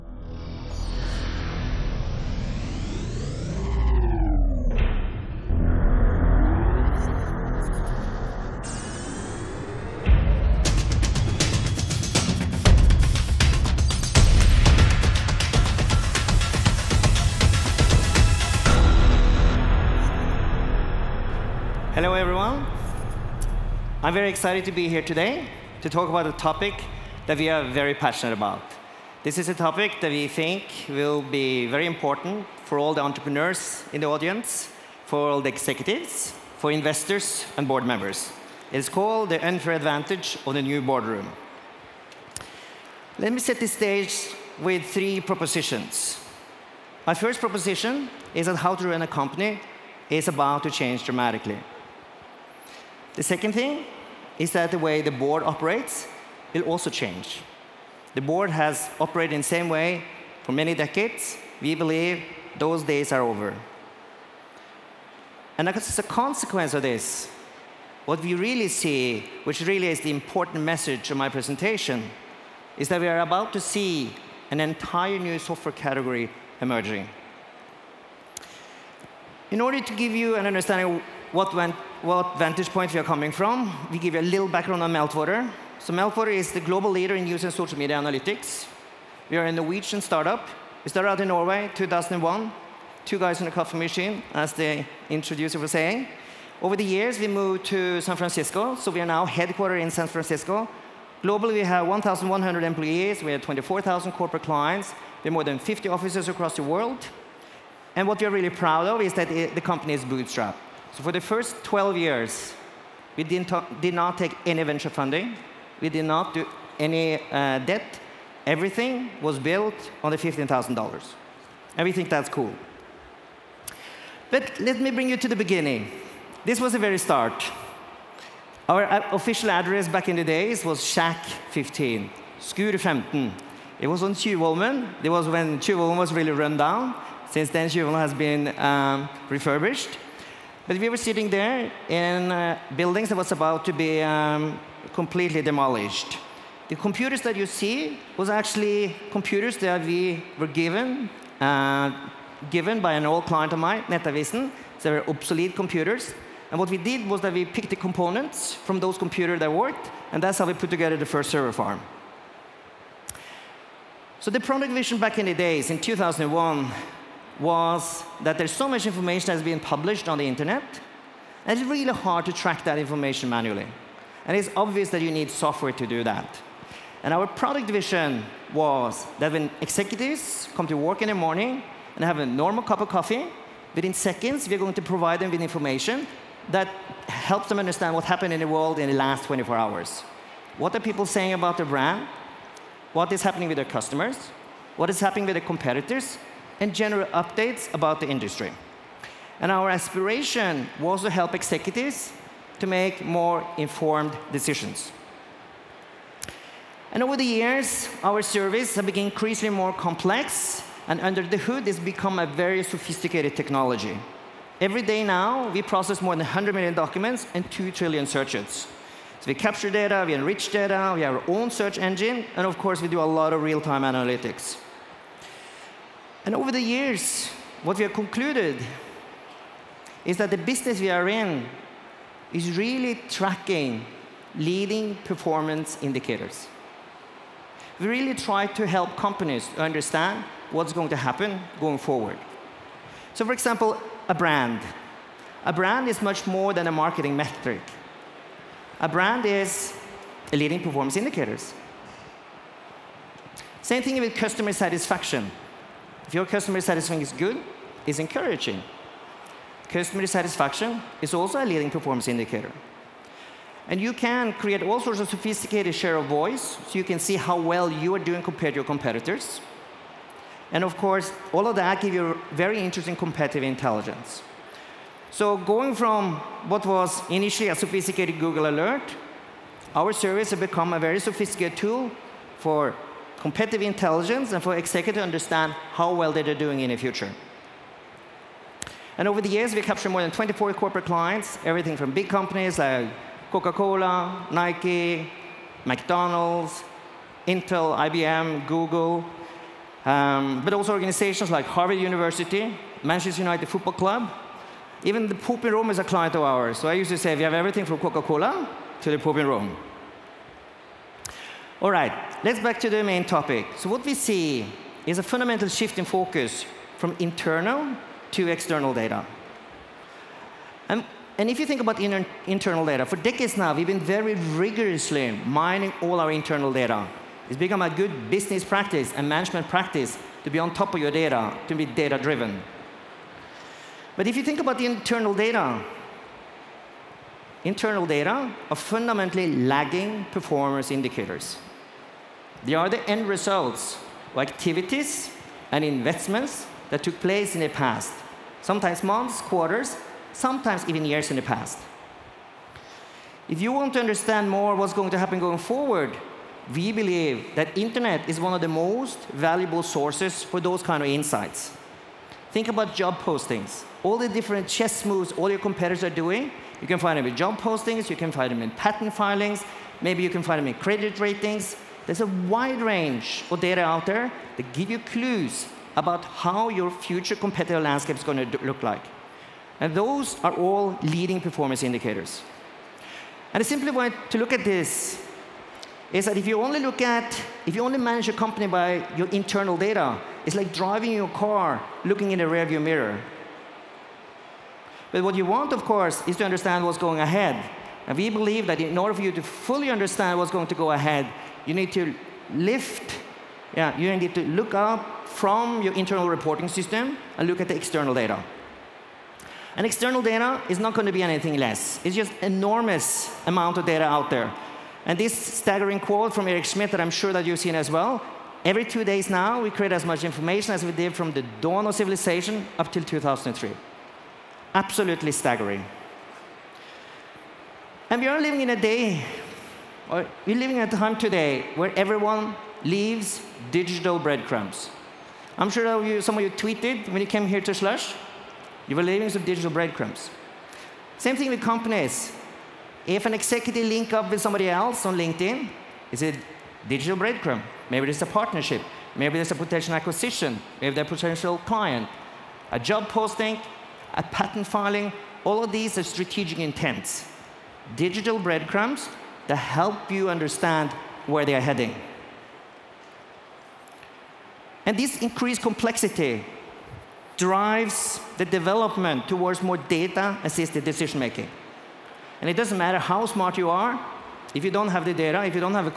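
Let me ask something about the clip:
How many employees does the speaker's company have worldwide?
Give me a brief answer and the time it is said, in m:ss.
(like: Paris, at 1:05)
1,100, at 1:41.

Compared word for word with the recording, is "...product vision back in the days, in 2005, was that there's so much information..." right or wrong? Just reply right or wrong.
wrong.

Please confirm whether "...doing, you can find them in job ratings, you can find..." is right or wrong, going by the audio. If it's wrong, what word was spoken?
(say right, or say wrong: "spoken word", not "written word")
wrong: "postings", not "ratings".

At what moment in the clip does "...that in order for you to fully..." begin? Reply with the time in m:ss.
6:38.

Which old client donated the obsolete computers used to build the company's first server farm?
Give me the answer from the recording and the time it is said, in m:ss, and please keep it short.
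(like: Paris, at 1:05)
Nettavisen, at 2:33.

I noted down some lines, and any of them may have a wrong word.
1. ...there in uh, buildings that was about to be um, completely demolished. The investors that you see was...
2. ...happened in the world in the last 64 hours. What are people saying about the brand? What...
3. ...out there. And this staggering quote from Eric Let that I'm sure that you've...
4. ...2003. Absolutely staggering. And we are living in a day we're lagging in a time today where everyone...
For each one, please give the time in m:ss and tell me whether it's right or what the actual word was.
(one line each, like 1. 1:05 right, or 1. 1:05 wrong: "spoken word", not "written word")
1. 2:21 wrong: "computers", not "investors"
2. 3:08 wrong: "24", not "64"
3. 6:53 wrong: "Schmidt", not "Let"
4. 7:02 wrong: "living", not "lagging".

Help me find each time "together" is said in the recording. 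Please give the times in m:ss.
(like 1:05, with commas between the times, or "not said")
2:40.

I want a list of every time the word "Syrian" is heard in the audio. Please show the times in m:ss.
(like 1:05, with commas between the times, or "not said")
not said.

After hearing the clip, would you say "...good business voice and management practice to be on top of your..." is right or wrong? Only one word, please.
wrong.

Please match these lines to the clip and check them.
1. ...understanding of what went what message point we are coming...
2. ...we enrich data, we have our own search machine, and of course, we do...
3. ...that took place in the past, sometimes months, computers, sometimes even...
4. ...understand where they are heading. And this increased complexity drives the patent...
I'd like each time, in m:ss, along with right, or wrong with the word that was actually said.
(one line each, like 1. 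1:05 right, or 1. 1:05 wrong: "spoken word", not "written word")
1. 1:20 wrong: "vantage", not "message"
2. 3:40 wrong: "engine", not "machine"
3. 5:46 wrong: "quarters", not "computers"
4. 7:40 wrong: "development", not "patent".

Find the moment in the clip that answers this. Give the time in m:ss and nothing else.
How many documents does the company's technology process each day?
3:36.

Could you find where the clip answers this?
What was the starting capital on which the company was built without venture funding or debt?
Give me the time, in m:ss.
2:00.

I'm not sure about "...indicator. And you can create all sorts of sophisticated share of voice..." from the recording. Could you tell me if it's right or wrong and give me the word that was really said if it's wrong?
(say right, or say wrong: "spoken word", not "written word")
right.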